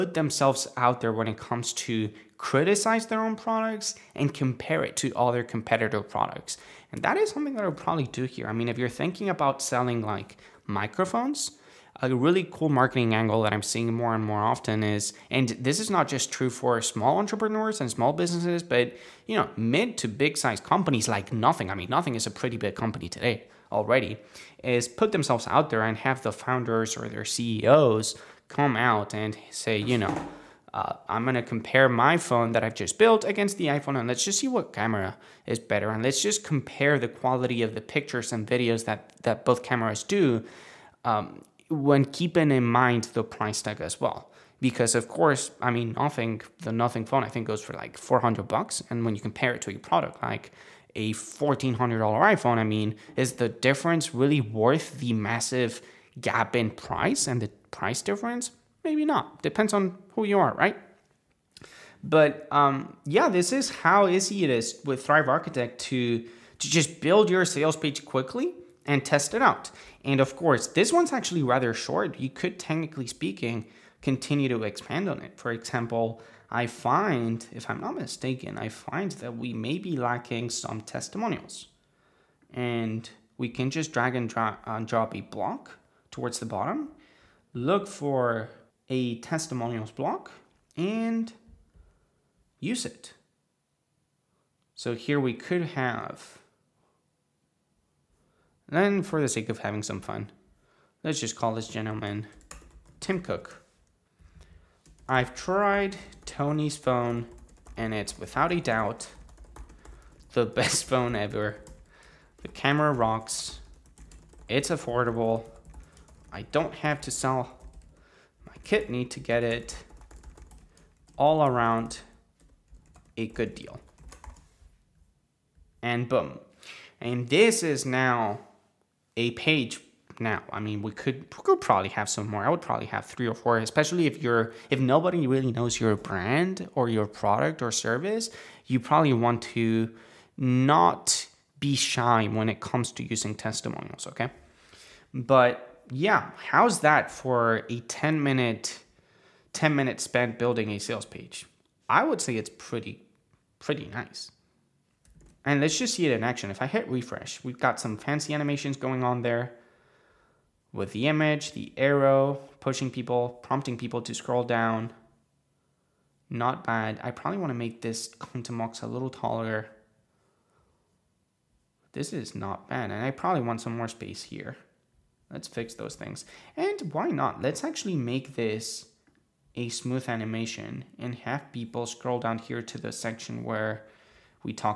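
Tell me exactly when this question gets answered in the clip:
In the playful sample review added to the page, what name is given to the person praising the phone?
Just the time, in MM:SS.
01:42.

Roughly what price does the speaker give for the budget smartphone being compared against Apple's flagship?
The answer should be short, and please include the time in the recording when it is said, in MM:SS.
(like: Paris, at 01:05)
$400, at 00:47.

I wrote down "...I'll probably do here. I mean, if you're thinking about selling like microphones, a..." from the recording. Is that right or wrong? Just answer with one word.
right.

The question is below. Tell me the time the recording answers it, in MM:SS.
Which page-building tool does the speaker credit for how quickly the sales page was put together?
01:05.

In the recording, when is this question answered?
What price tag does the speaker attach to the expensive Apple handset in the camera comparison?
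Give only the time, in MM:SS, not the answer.
00:51.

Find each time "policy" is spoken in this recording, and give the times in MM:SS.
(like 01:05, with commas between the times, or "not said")
not said.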